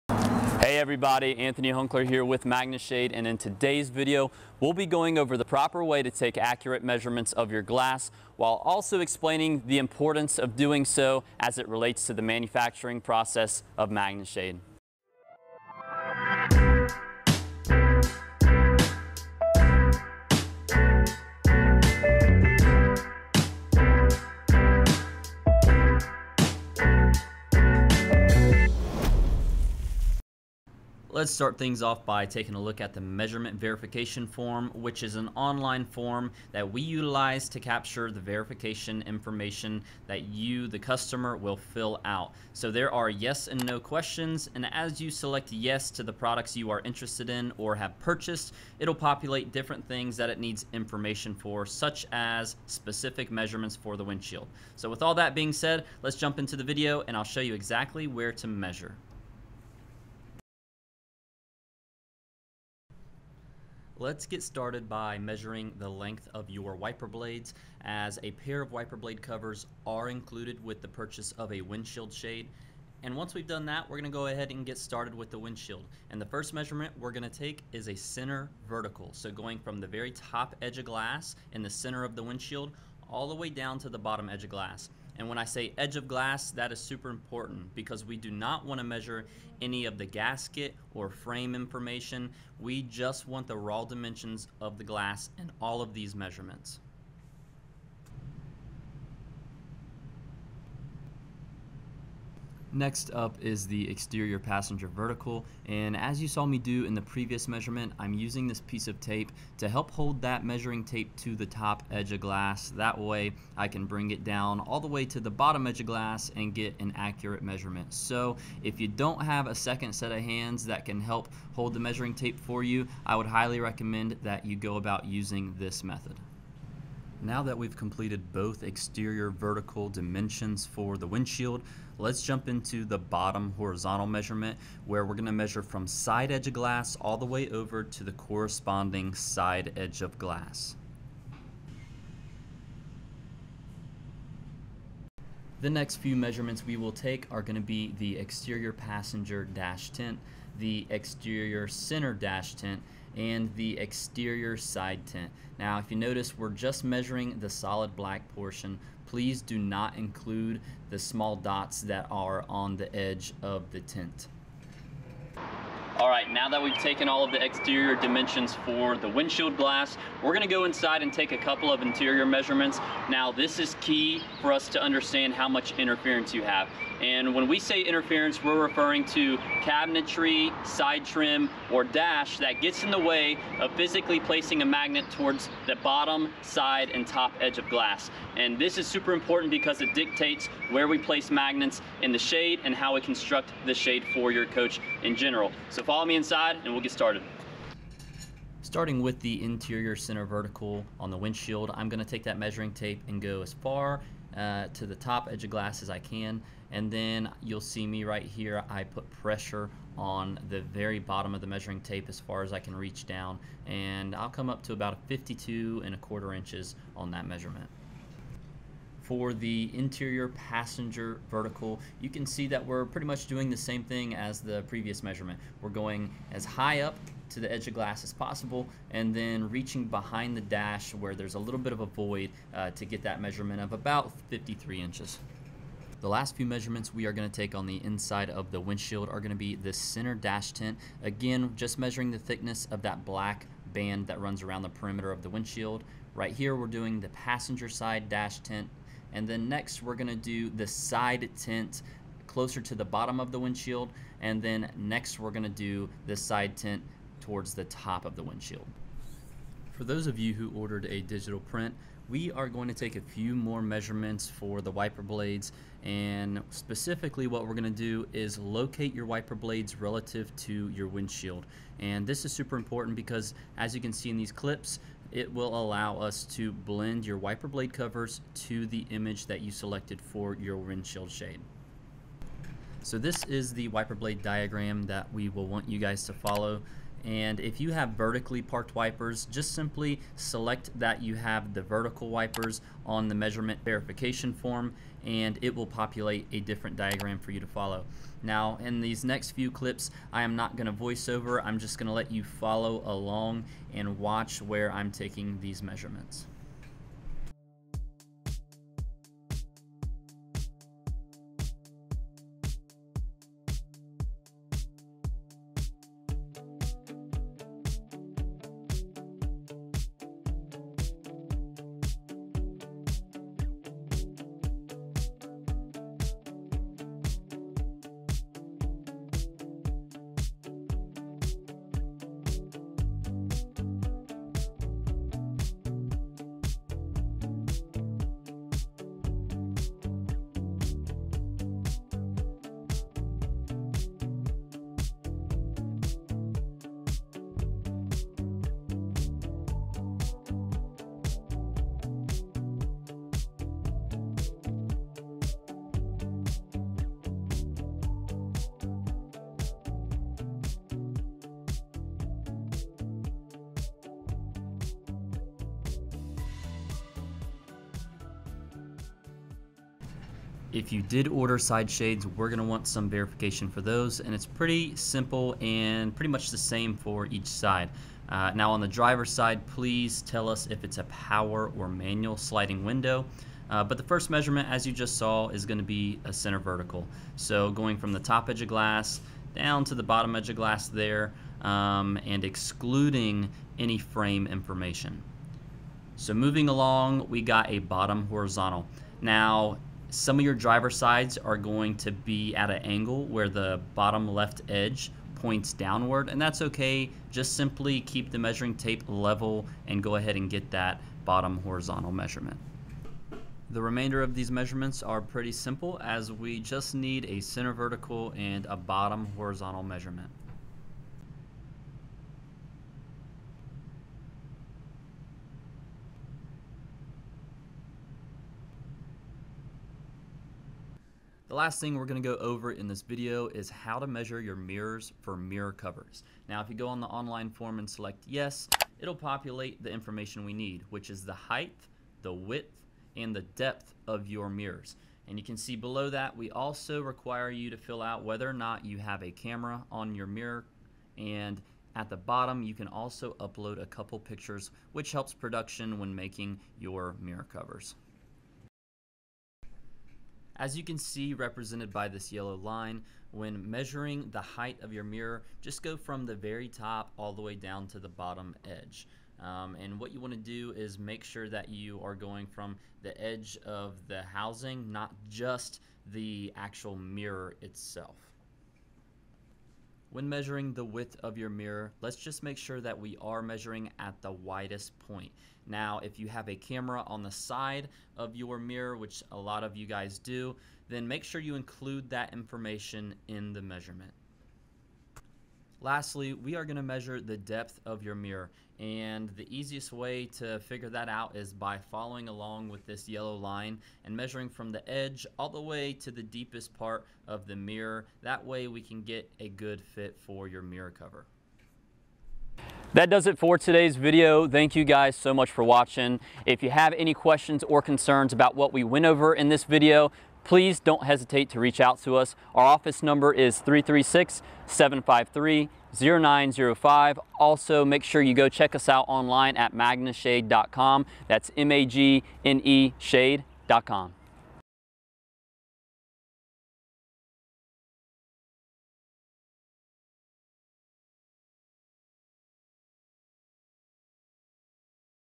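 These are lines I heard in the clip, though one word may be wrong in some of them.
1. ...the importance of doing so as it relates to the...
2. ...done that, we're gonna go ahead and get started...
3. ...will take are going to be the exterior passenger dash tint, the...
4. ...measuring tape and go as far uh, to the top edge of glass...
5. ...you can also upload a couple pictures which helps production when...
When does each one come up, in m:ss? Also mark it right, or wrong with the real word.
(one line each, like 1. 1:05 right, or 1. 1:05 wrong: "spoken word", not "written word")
1. 0:09 right
2. 1:13 right
3. 2:26 right
4. 3:22 right
5. 7:32 right.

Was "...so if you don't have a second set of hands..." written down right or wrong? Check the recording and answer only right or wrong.
right.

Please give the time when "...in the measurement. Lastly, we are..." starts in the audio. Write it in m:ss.
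8:13.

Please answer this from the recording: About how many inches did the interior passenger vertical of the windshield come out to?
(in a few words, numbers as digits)
53 inches.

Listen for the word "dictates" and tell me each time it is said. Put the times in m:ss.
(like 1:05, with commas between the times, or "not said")
3:09.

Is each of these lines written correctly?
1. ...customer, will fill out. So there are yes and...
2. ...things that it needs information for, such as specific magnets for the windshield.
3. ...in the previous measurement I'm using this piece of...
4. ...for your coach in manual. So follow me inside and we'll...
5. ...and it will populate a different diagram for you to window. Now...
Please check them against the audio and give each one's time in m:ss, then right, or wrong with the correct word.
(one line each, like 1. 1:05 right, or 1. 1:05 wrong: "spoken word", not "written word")
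1. 0:40 right
2. 0:49 wrong: "measurements", not "magnets"
3. 1:46 right
4. 3:14 wrong: "general", not "manual"
5. 4:55 wrong: "follow", not "window".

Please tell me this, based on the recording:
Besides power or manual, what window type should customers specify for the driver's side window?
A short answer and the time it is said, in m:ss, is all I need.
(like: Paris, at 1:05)
sliding, at 6:22.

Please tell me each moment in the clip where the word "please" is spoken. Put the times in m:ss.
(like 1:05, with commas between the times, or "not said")
2:39, 6:19, 8:40.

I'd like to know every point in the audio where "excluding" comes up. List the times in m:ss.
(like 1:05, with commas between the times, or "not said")
6:32.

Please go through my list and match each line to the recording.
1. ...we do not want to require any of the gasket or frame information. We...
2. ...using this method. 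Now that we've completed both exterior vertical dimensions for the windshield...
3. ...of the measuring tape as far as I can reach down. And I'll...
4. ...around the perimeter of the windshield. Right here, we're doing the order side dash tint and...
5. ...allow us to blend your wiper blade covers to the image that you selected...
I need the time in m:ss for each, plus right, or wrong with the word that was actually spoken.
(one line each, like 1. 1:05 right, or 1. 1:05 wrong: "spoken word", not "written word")
1. 1:28 wrong: "measure", not "require"
2. 2:05 right
3. 3:31 right
4. 4:04 wrong: "passenger", not "order"
5. 4:35 right.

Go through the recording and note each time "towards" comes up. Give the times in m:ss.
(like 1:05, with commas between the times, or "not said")
3:05, 4:17.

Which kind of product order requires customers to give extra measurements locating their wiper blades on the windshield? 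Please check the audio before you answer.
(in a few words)
digital print.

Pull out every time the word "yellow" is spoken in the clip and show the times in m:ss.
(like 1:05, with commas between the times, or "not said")
7:42, 8:22.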